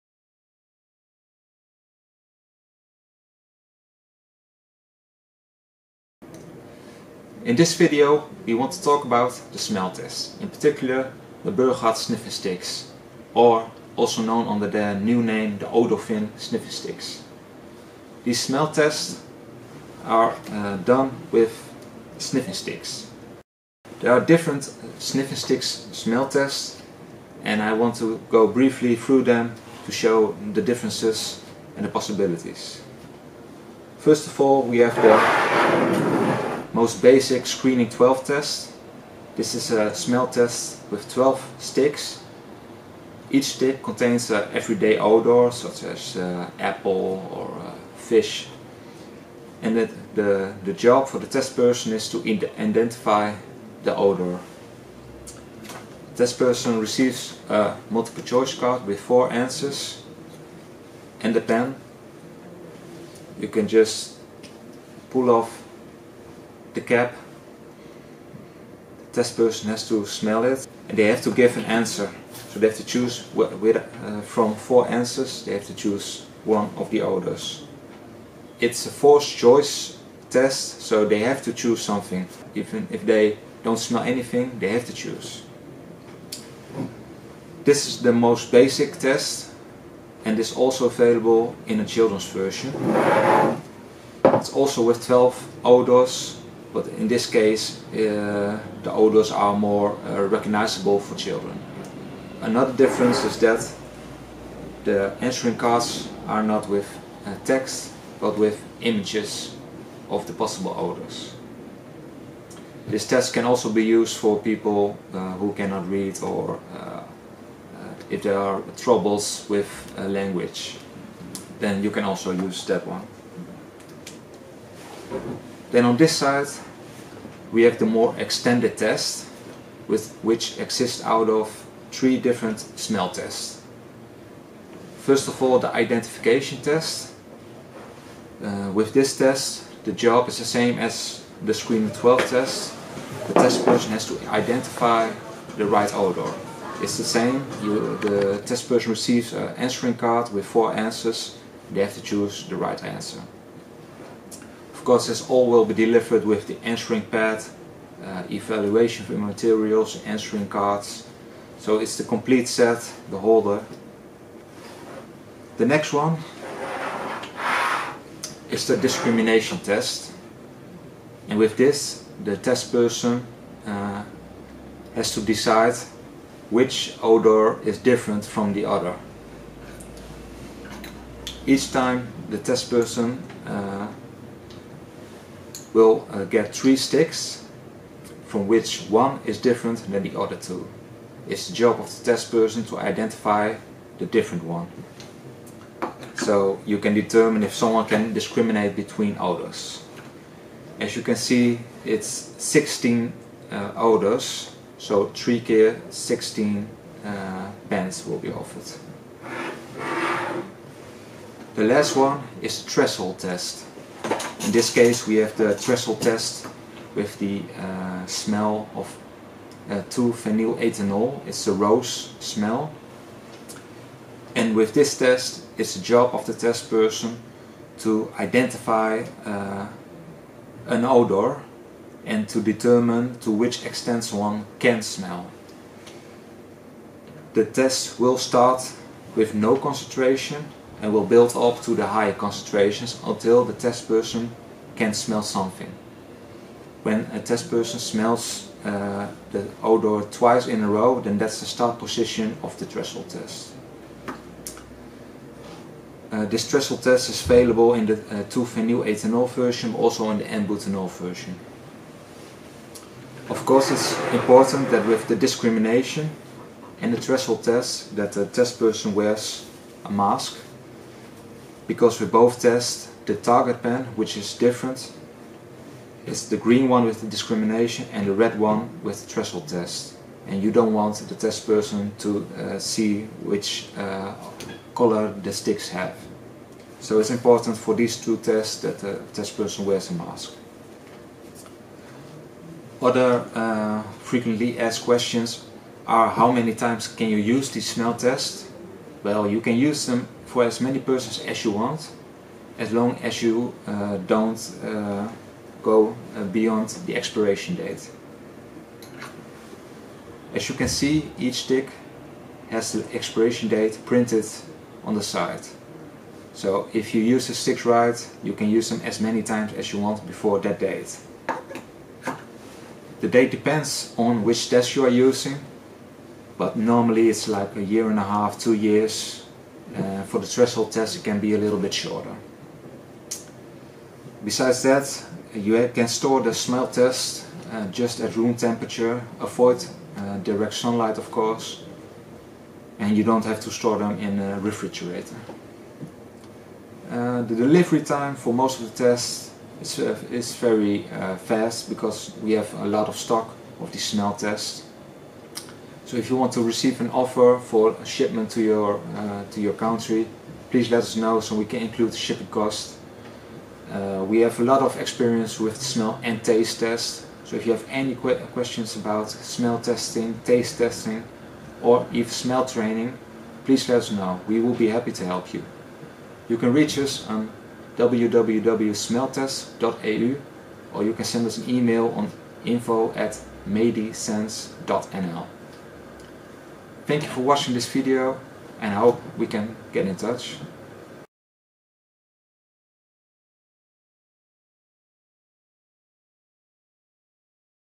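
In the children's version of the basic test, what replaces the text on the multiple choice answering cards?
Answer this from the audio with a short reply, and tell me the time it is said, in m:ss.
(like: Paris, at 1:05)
images, at 1:48.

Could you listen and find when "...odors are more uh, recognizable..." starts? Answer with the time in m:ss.
1:38.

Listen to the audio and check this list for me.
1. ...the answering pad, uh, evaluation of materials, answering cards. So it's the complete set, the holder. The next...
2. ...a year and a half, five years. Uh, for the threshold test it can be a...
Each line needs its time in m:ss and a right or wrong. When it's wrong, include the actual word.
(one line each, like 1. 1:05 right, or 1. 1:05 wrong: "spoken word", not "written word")
1. 2:36 right
2. 5:27 wrong: "two", not "five".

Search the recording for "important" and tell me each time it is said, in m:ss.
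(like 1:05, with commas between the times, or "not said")
4:24, 4:47.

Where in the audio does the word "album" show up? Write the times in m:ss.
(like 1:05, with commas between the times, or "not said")
not said.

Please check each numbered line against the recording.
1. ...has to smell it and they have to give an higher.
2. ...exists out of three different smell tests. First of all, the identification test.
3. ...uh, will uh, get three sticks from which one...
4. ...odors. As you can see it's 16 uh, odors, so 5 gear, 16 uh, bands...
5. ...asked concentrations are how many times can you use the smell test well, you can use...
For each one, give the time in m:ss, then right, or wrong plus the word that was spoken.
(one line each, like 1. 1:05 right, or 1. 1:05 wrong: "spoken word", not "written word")
1. 1:09 wrong: "answer", not "higher"
2. 2:10 right
3. 3:03 right
4. 3:19 wrong: "3", not "5"
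5. 4:54 wrong: "questions", not "concentrations".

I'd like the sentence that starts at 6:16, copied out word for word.
You can reach us on www.smelltest.eu, or you can send us an email on info at medisense.nl.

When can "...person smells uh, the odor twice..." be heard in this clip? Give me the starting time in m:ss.
4:07.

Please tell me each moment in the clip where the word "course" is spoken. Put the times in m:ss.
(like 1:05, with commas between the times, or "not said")
2:34, 4:23, 5:41.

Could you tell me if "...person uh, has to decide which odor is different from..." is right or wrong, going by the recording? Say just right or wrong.
right.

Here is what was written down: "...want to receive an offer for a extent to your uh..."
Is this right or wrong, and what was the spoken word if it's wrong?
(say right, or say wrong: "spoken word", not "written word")
wrong: "shipment", not "extent".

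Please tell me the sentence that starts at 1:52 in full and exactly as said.
This test can also be used for people uh, who cannot read or uh, if there are troubles with uh, language.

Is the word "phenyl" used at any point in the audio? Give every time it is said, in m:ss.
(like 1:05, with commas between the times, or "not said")
3:39, 4:18.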